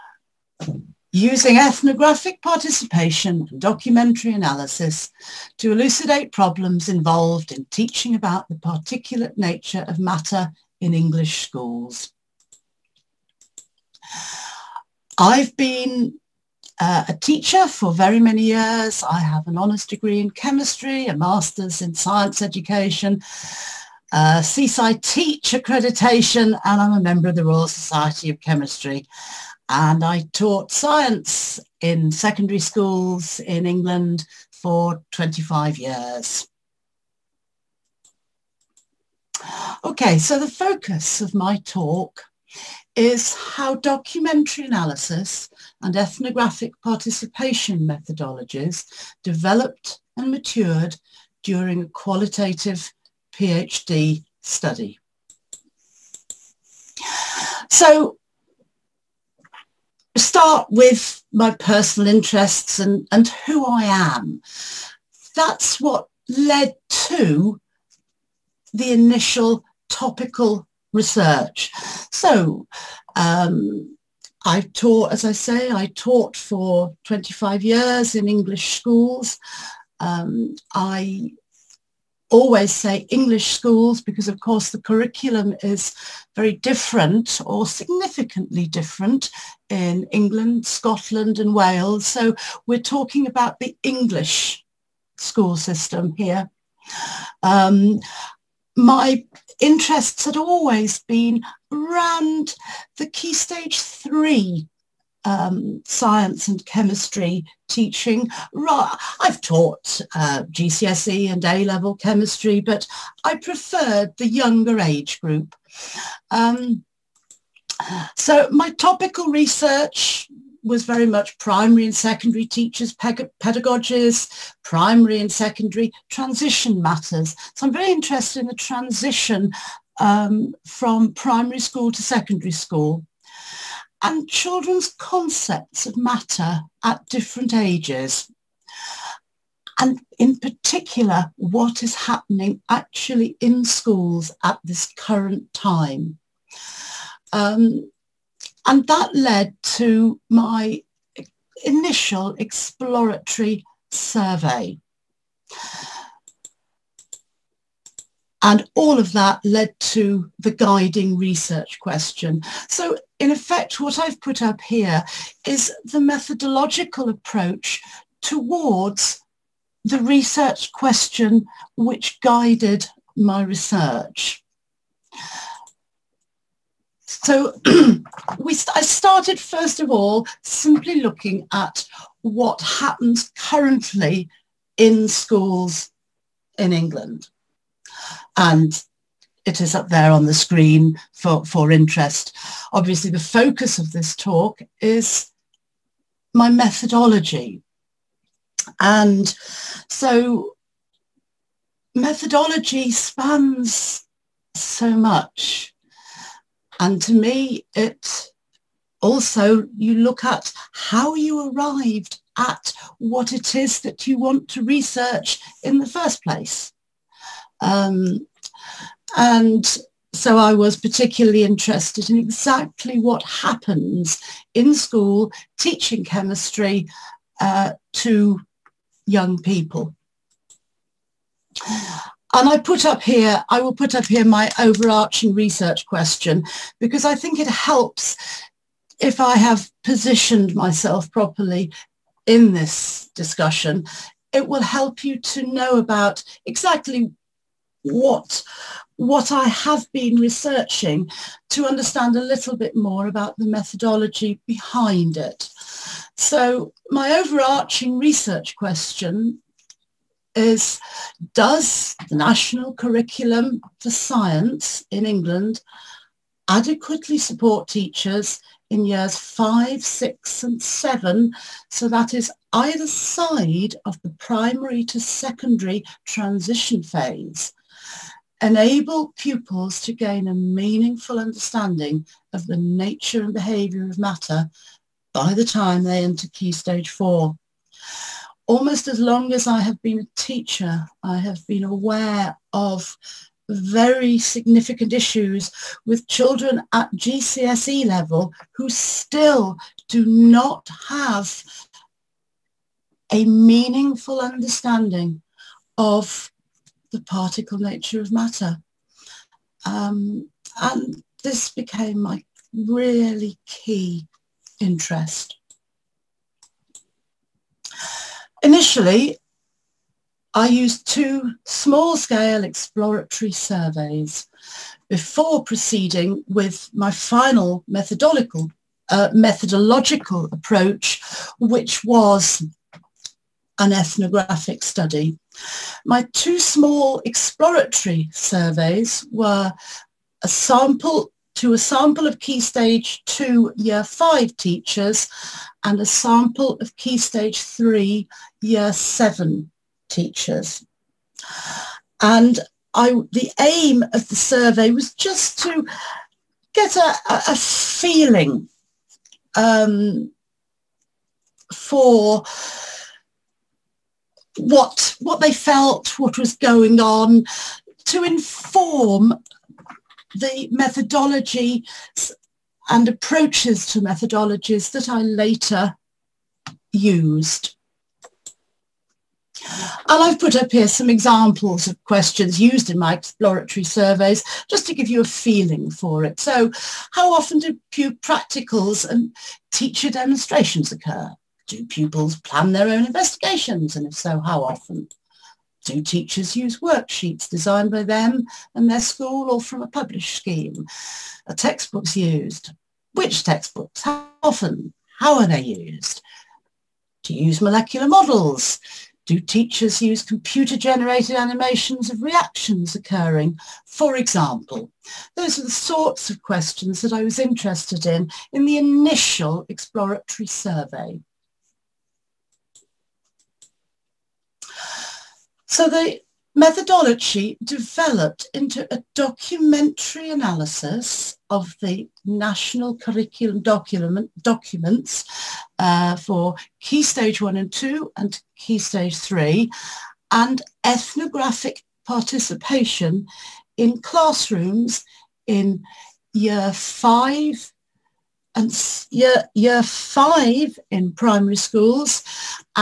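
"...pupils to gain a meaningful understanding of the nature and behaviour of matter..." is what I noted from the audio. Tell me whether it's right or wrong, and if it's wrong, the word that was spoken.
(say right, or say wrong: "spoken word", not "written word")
right.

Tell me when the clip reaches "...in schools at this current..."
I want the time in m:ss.
2:23.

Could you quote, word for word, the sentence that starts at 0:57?
So start with my personal interests and, and who I am.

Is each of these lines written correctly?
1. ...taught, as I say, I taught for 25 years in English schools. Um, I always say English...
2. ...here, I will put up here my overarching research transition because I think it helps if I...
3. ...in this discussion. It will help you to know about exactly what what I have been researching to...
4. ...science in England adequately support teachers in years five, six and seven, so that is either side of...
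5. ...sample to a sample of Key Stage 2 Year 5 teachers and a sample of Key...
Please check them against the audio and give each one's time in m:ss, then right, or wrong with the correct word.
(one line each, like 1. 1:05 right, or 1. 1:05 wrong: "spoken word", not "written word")
1. 1:14 right
2. 3:53 wrong: "question", not "transition"
3. 4:02 right
4. 4:23 right
5. 5:40 right.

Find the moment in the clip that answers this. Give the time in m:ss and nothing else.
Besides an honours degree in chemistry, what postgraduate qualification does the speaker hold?
0:21.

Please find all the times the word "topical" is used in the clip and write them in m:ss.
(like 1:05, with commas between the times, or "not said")
1:09, 1:58.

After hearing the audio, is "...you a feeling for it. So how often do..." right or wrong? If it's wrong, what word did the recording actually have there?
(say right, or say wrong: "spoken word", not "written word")
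right.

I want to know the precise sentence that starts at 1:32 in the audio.
So we're talking about the English school system here.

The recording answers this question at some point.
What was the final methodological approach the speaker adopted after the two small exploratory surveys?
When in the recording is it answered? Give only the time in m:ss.
5:33.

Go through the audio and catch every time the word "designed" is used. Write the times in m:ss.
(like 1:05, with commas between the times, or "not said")
6:37.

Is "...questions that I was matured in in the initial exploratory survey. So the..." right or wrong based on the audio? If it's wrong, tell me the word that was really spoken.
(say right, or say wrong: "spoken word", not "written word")
wrong: "interested", not "matured".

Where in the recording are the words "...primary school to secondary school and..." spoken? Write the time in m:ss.
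2:11.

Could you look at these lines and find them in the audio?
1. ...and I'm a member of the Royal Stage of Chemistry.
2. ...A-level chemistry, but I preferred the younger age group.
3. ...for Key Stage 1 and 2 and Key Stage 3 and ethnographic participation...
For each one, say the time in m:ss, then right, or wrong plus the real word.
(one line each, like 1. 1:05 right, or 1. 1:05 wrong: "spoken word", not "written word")
1. 0:26 wrong: "Society", not "Stage"
2. 1:51 right
3. 7:15 right.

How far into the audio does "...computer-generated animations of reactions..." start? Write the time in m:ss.
6:50.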